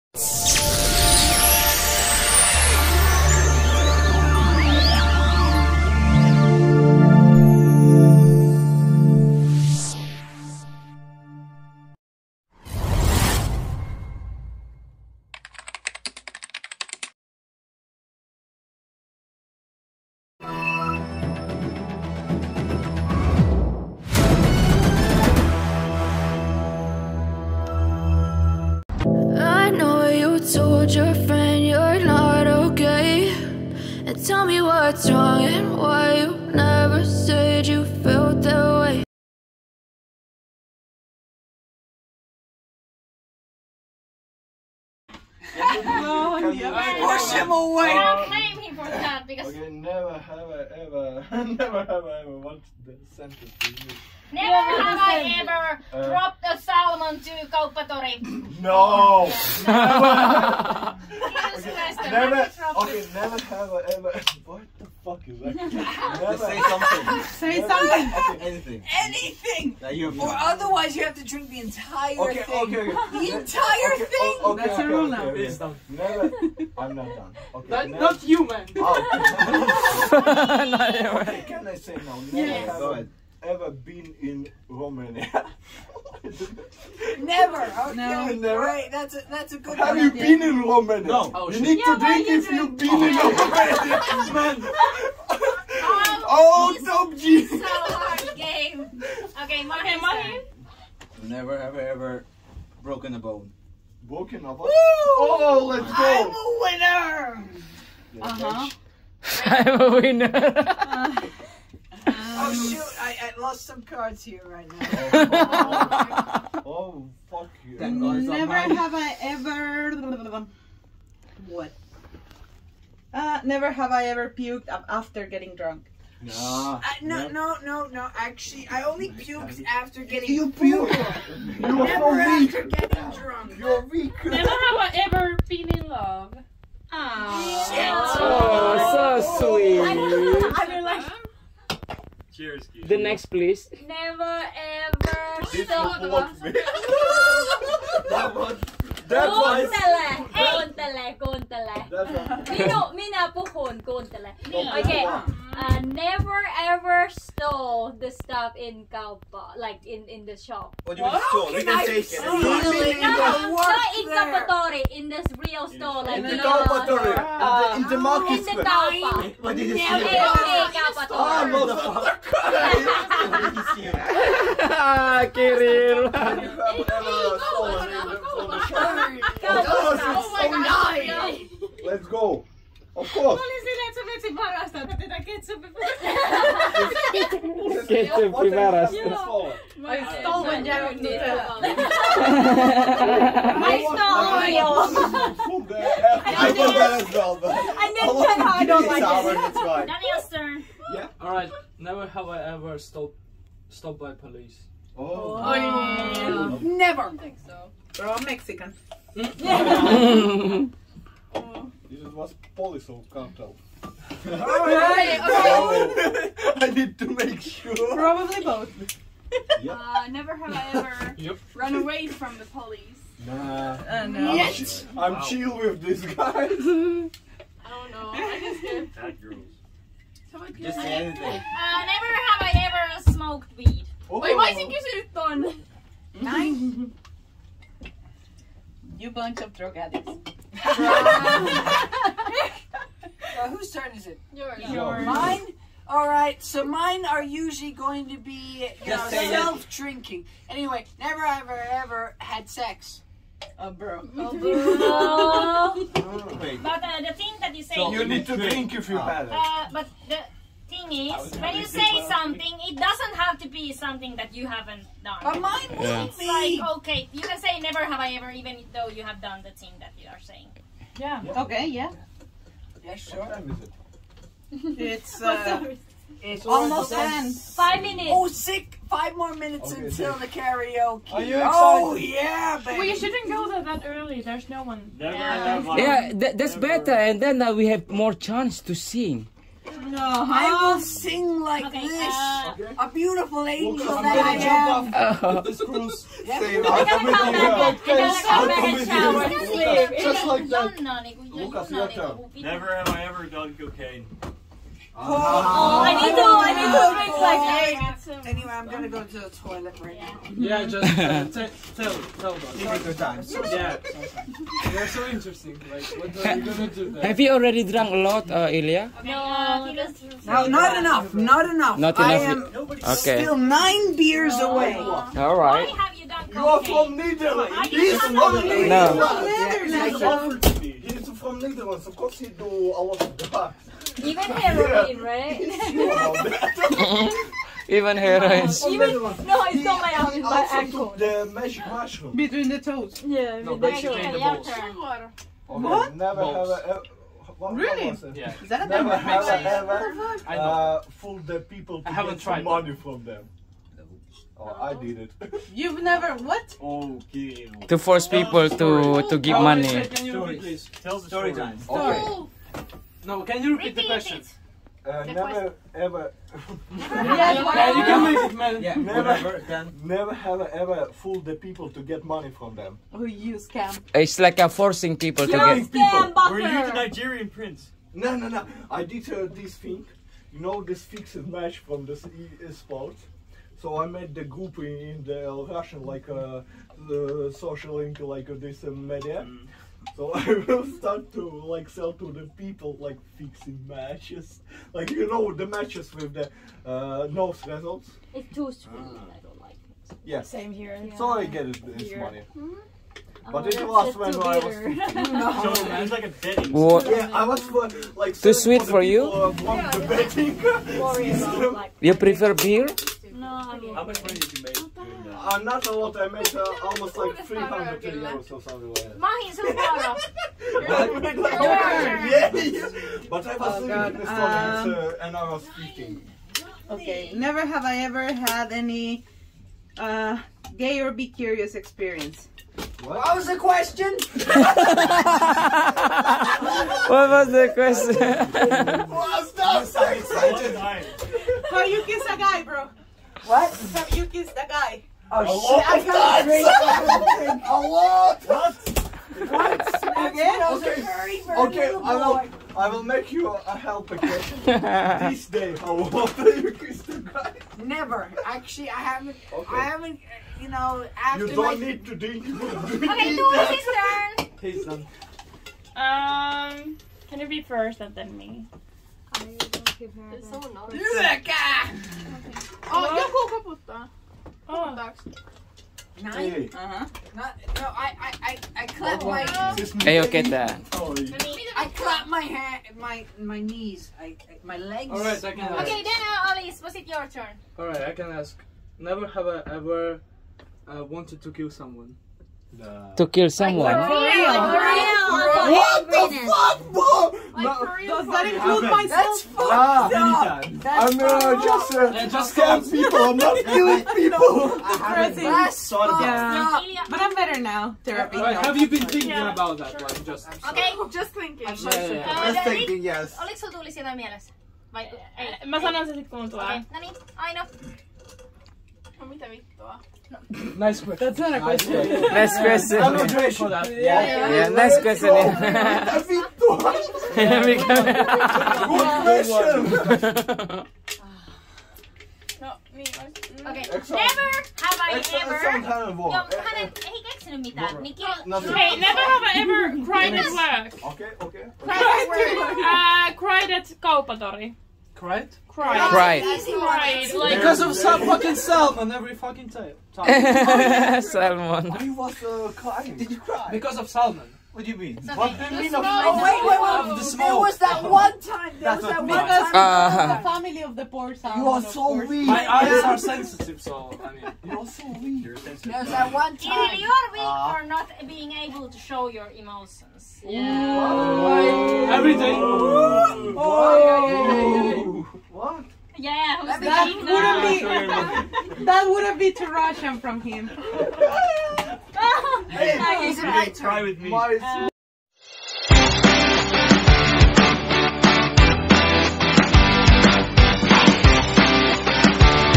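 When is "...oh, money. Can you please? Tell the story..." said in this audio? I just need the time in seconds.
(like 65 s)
359 s.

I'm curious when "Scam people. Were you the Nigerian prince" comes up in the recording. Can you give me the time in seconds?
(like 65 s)
375 s.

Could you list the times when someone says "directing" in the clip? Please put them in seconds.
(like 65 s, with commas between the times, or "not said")
not said.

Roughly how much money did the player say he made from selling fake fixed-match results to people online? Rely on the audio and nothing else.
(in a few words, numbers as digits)
300 euros.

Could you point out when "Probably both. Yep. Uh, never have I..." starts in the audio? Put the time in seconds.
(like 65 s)
217 s.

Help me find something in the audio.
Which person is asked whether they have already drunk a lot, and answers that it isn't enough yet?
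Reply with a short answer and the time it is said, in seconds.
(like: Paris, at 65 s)
Ilya, at 318 s.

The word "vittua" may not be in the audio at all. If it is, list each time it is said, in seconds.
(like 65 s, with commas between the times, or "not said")
519 s, 526 s.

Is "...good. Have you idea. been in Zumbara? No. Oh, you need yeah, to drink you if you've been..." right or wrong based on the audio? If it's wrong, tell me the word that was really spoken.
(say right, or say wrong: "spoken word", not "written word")
wrong: "Romania", not "Zumbara".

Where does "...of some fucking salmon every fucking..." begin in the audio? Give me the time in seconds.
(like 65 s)
547 s.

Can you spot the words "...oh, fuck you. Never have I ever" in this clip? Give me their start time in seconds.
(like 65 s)
117 s.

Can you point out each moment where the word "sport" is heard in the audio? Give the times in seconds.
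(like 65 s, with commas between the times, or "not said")
382 s.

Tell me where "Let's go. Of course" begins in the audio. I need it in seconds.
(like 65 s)
181 s.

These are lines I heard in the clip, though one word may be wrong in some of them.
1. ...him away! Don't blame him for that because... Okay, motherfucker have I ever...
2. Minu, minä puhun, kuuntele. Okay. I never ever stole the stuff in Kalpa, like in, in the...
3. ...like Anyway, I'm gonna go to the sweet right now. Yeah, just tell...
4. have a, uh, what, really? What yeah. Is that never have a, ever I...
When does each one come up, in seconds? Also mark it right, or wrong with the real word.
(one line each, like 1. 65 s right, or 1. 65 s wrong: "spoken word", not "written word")
1. 47 s wrong: "never", not "motherfucker"
2. 152 s right
3. 307 s wrong: "toilet", not "sweet"
4. 346 s right.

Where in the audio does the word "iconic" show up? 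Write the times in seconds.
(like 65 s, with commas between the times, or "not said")
not said.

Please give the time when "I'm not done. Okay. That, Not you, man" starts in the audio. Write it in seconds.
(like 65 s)
76 s.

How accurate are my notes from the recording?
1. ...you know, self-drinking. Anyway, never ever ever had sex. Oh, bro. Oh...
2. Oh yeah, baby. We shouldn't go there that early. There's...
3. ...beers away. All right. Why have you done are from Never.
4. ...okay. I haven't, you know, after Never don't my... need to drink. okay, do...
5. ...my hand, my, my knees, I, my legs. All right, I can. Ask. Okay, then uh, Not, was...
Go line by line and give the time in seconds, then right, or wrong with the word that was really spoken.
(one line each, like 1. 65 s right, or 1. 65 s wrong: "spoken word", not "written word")
1. 248 s right
2. 281 s right
3. 323 s wrong: "Netherlands", not "Never"
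4. 459 s wrong: "You", not "Never"
5. 482 s wrong: "Alice", not "Not".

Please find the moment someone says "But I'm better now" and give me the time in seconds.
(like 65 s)
506 s.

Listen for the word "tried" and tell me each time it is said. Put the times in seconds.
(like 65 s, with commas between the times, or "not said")
352 s.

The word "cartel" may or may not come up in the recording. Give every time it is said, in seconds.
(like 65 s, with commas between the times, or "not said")
213 s.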